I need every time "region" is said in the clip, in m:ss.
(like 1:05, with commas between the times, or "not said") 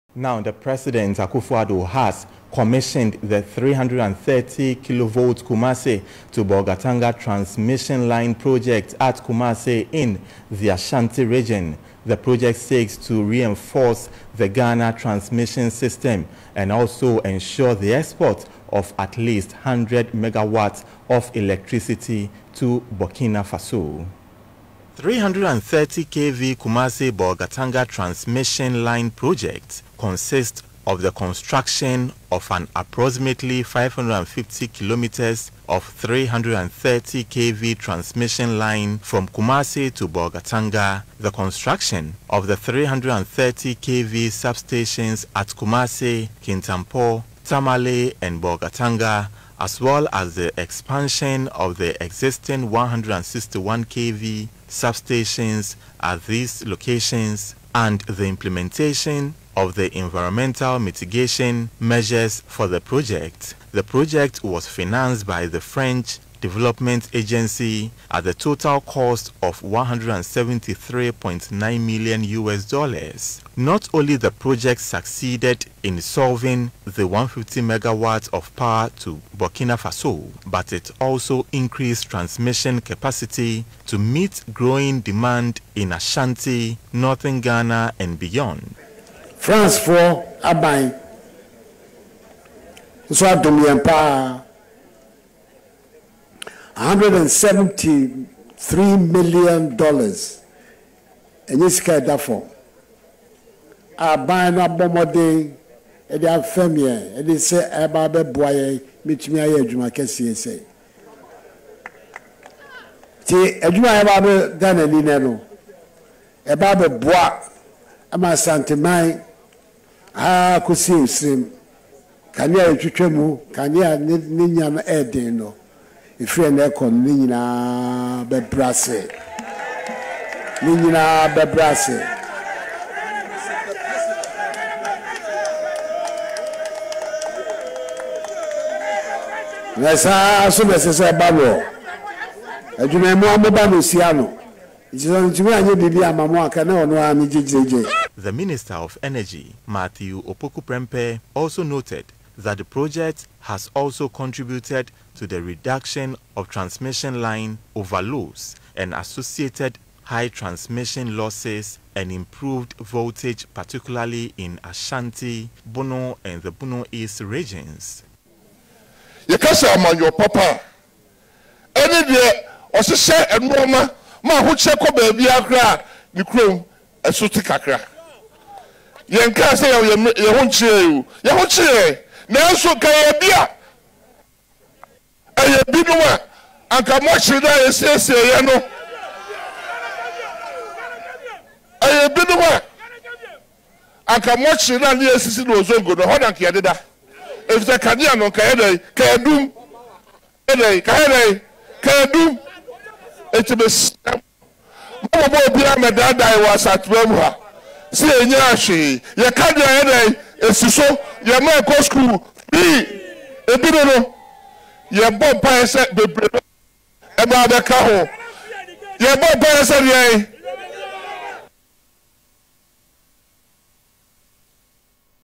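0:11, 2:47.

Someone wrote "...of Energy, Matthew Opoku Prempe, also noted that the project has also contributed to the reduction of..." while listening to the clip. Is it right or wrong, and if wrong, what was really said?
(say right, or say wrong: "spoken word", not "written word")
right.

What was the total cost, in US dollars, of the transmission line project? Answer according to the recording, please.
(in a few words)
173.9 million.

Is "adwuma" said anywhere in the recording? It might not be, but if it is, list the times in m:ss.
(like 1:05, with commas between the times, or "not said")
1:49, 1:53, 2:22.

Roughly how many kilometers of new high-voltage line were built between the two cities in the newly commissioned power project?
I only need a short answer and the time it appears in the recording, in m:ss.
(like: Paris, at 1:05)
550, at 0:33.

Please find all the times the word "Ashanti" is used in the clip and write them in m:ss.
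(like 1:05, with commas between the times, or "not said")
0:10, 1:25, 2:44.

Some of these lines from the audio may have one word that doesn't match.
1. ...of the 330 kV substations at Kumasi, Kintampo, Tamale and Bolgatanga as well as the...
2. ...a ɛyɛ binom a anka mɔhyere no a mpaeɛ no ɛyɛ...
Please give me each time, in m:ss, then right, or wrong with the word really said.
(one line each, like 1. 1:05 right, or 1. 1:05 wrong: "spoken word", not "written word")
1. 0:42 right
2. 3:03 wrong: "yɛsiesieɛ", not "mpaeɛ".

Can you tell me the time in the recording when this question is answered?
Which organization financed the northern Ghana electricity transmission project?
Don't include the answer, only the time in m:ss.
1:05.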